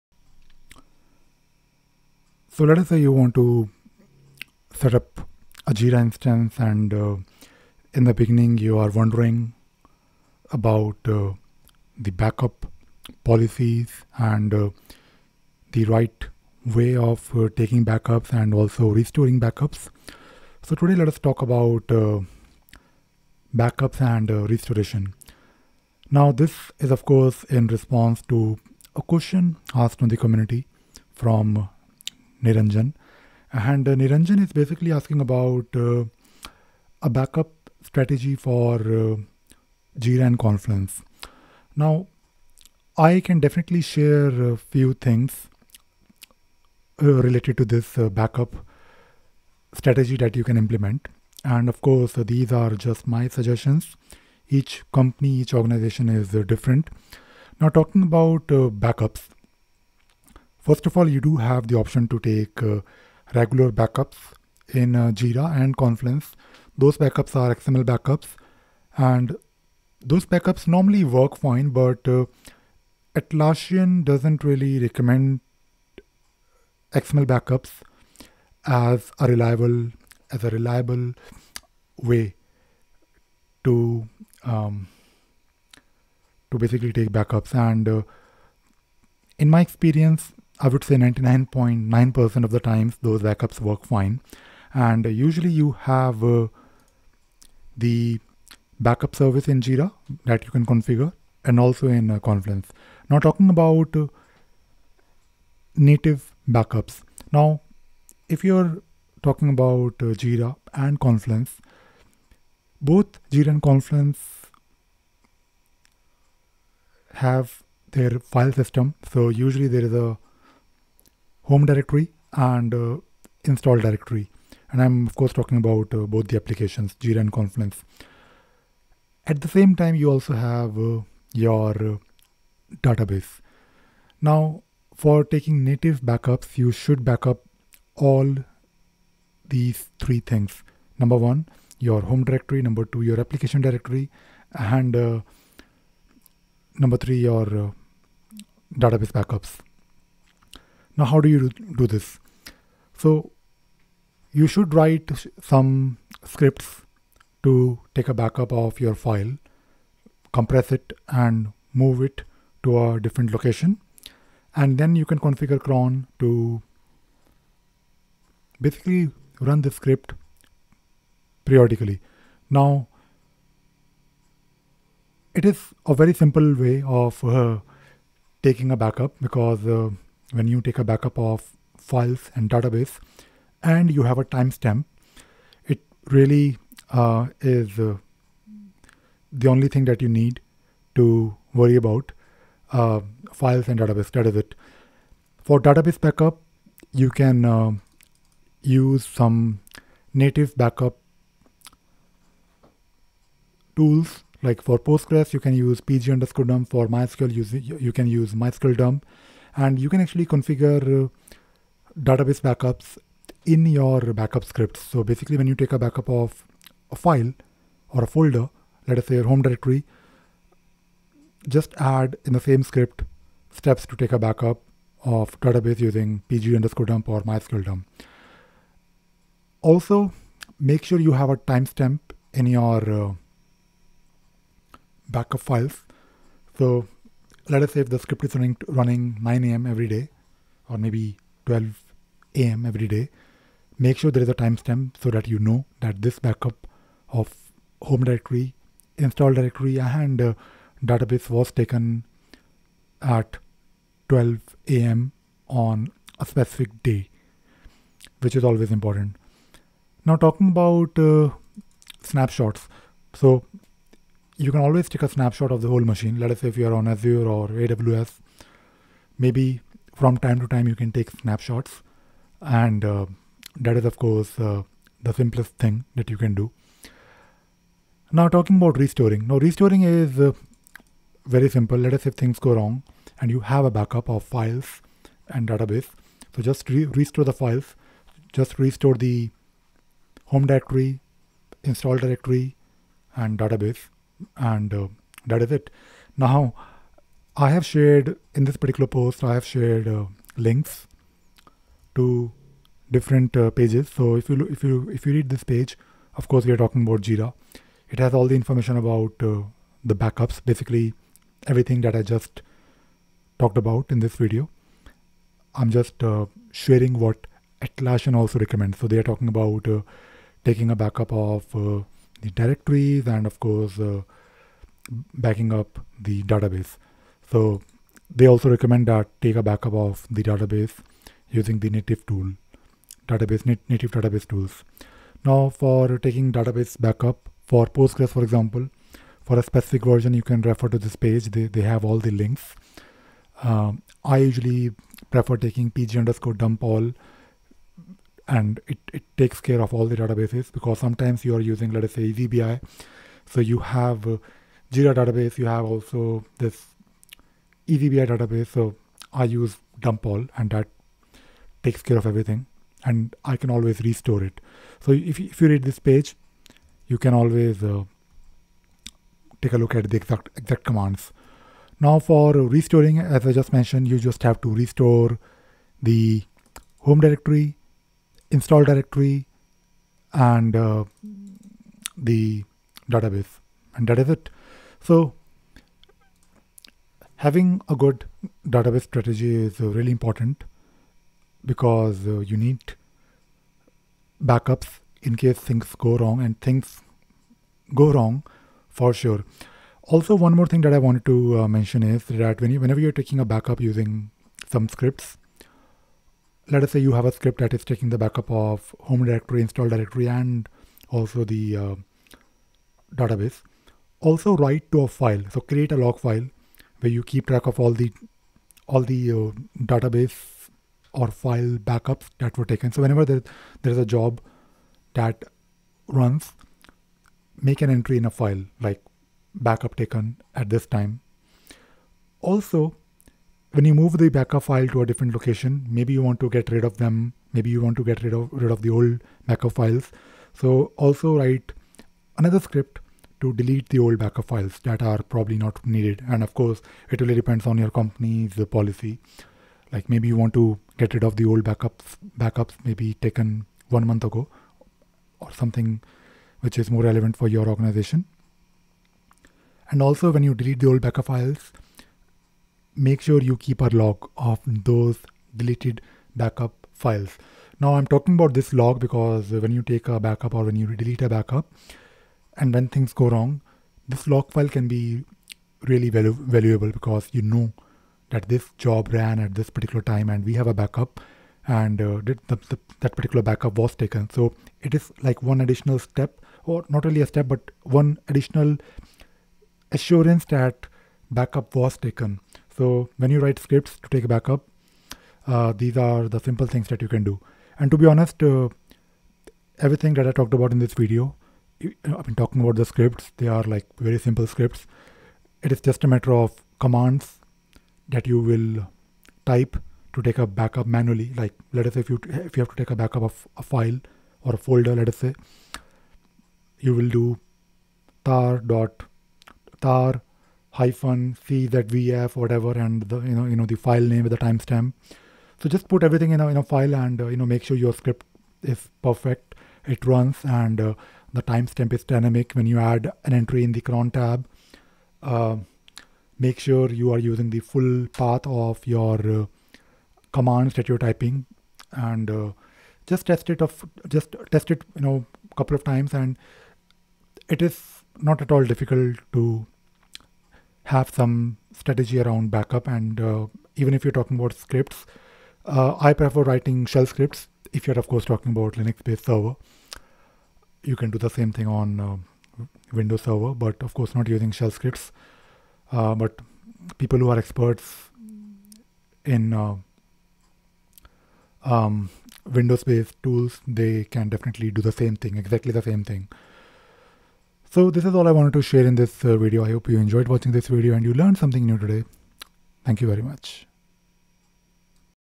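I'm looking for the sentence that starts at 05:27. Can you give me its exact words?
So they also recommend that take a backup of the database using the native tool, database nat native database tools.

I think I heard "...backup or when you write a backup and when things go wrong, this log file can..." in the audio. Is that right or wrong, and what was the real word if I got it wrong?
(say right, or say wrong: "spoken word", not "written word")
wrong: "delete", not "write".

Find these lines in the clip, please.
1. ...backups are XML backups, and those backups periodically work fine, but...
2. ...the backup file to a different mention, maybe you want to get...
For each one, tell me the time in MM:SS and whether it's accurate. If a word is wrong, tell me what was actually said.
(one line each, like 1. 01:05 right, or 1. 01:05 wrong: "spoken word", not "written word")
1. 01:06 wrong: "normally", not "periodically"
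2. 07:13 wrong: "location", not "mention".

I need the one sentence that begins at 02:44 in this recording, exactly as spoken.
And then you can configure cron to basically run the script periodically.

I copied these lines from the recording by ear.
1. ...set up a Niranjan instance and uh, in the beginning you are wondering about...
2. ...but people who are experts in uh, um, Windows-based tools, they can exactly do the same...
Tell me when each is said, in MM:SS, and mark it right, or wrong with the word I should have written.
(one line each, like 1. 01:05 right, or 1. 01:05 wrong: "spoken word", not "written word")
1. 00:04 wrong: "Jira", not "Niranjan"
2. 09:25 wrong: "definitely", not "exactly".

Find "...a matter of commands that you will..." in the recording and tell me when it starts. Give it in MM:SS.
08:25.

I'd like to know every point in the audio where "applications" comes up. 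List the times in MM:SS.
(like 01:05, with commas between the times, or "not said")
02:06, 02:23.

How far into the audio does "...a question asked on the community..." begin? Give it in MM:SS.
00:28.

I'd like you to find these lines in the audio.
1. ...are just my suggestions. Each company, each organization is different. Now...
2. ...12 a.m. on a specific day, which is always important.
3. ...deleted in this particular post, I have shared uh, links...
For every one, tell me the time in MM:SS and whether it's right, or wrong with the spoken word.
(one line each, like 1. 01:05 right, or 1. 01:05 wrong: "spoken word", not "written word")
1. 00:52 right
2. 04:14 right
3. 04:57 wrong: "shared", not "deleted".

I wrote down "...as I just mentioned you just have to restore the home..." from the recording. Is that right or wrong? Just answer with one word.
right.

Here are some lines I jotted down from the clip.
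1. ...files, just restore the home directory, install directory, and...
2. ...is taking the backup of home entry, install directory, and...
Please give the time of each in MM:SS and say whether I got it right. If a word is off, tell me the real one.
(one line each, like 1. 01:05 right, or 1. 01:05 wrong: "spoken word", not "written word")
1. 04:47 right
2. 06:47 wrong: "directory", not "entry".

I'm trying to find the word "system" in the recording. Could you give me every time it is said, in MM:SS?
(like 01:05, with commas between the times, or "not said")
01:58.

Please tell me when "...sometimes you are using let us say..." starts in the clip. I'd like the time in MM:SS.
05:50.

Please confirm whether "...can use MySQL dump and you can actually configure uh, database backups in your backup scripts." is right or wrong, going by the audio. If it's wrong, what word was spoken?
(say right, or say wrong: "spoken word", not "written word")
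right.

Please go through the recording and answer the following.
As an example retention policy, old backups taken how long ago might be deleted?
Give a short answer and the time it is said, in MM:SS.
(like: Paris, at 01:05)
One month, at 07:33.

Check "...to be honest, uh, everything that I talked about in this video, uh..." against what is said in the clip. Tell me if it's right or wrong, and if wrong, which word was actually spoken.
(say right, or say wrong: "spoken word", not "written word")
right.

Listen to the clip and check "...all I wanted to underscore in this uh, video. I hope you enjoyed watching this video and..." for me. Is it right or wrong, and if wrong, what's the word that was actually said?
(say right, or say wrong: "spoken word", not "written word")
wrong: "share", not "underscore".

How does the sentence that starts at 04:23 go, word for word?
So, you can always take a snapshot of the whole machine.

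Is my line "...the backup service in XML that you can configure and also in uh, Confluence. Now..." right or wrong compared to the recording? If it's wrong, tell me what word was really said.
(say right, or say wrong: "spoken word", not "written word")
wrong: "Jira", not "XML".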